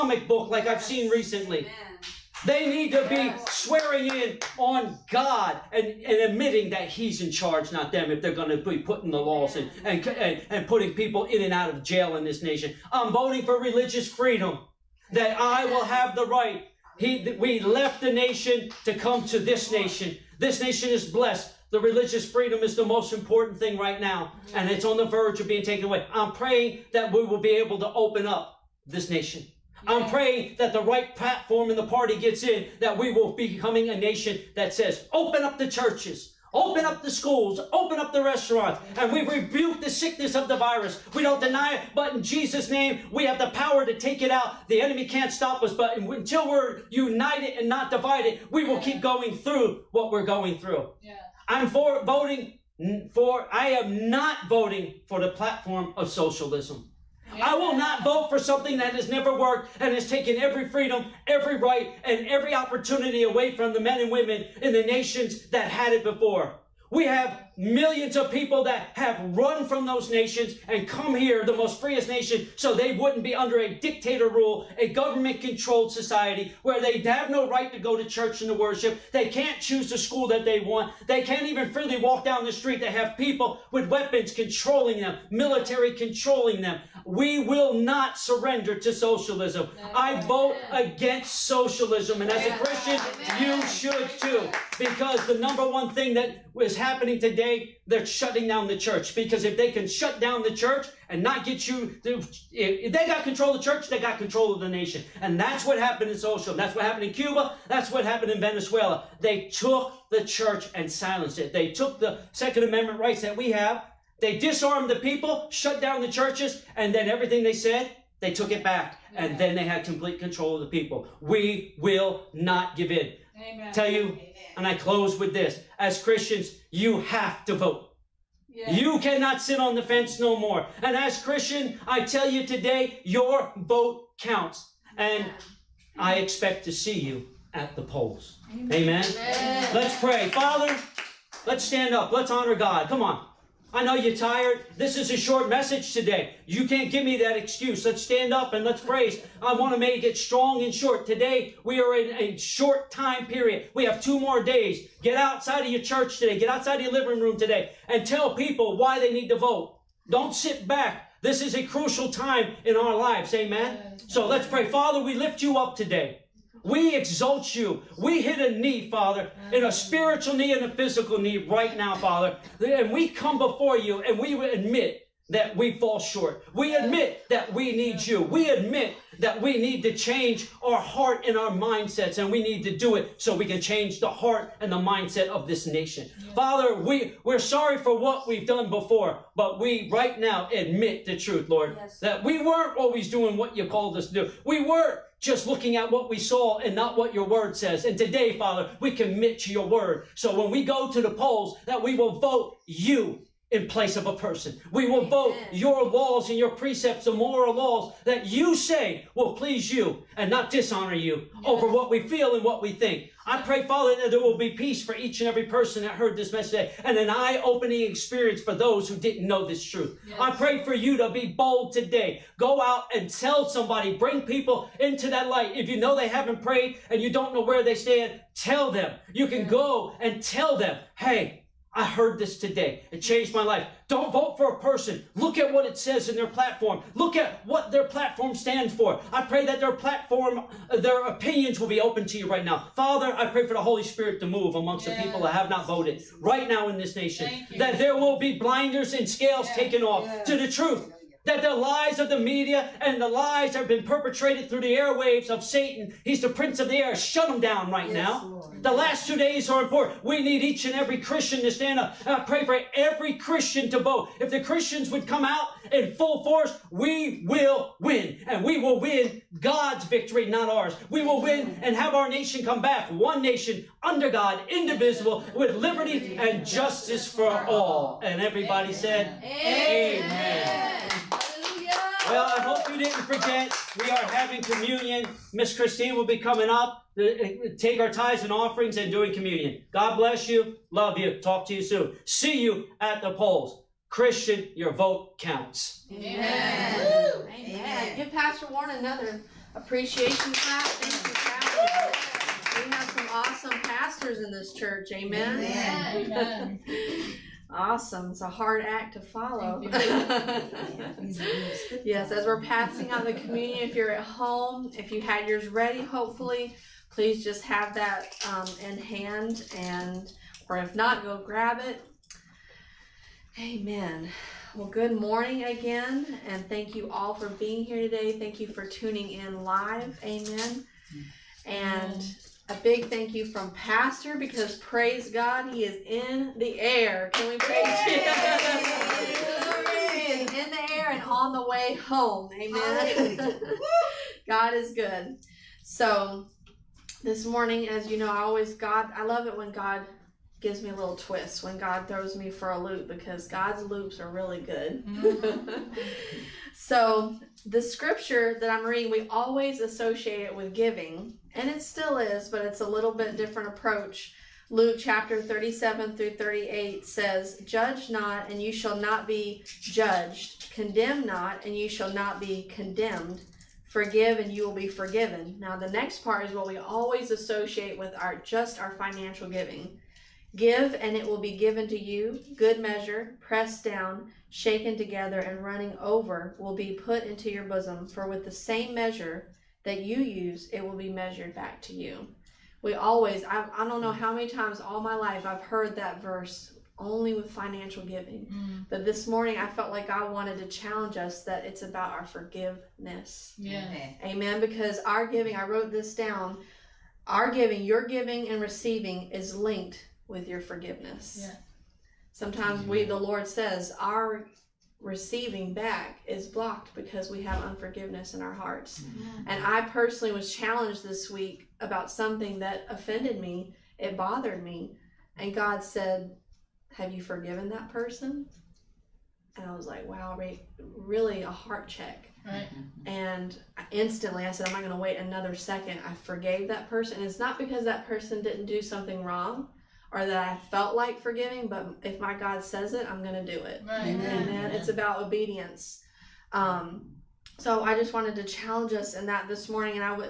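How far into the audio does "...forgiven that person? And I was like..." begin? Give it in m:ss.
7:07.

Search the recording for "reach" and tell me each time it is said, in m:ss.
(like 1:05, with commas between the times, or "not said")
not said.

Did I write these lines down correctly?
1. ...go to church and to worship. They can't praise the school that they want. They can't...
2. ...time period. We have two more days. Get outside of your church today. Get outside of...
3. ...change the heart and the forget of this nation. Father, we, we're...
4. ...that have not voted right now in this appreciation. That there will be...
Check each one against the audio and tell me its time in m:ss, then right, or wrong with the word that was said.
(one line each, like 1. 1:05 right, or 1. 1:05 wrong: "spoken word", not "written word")
1. 1:17 wrong: "choose", not "praise"
2. 2:32 right
3. 3:03 wrong: "mindset", not "forget"
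4. 4:05 wrong: "nation", not "appreciation".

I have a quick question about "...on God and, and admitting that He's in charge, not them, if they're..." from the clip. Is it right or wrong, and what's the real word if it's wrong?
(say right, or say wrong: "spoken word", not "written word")
right.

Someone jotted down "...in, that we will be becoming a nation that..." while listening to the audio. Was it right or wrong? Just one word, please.
right.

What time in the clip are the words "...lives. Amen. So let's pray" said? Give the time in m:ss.
2:42.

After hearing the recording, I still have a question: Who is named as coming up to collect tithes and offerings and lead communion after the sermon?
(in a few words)
Miss Christine.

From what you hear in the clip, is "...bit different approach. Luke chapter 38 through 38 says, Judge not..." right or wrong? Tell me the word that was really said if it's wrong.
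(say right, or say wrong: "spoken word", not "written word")
wrong: "37", not "38".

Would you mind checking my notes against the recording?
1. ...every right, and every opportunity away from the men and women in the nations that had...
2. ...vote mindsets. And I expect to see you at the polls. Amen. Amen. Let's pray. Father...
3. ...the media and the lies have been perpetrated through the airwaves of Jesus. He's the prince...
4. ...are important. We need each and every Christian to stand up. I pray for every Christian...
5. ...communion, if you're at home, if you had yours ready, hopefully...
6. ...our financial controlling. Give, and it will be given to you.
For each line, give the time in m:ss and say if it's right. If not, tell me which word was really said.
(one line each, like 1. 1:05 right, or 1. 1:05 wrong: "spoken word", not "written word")
1. 1:01 right
2. 2:13 wrong: "counts", not "mindsets"
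3. 4:12 wrong: "Satan", not "Jesus"
4. 4:19 right
5. 5:13 right
6. 6:18 wrong: "giving", not "controlling".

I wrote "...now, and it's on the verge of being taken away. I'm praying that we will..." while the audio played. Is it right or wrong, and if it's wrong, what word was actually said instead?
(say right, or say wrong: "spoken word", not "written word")
right.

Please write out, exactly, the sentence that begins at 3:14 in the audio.
We were just looking at what we saw and not what your word says.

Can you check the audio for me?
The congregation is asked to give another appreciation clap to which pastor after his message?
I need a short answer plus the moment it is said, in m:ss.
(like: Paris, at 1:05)
Pastor Warren, at 4:58.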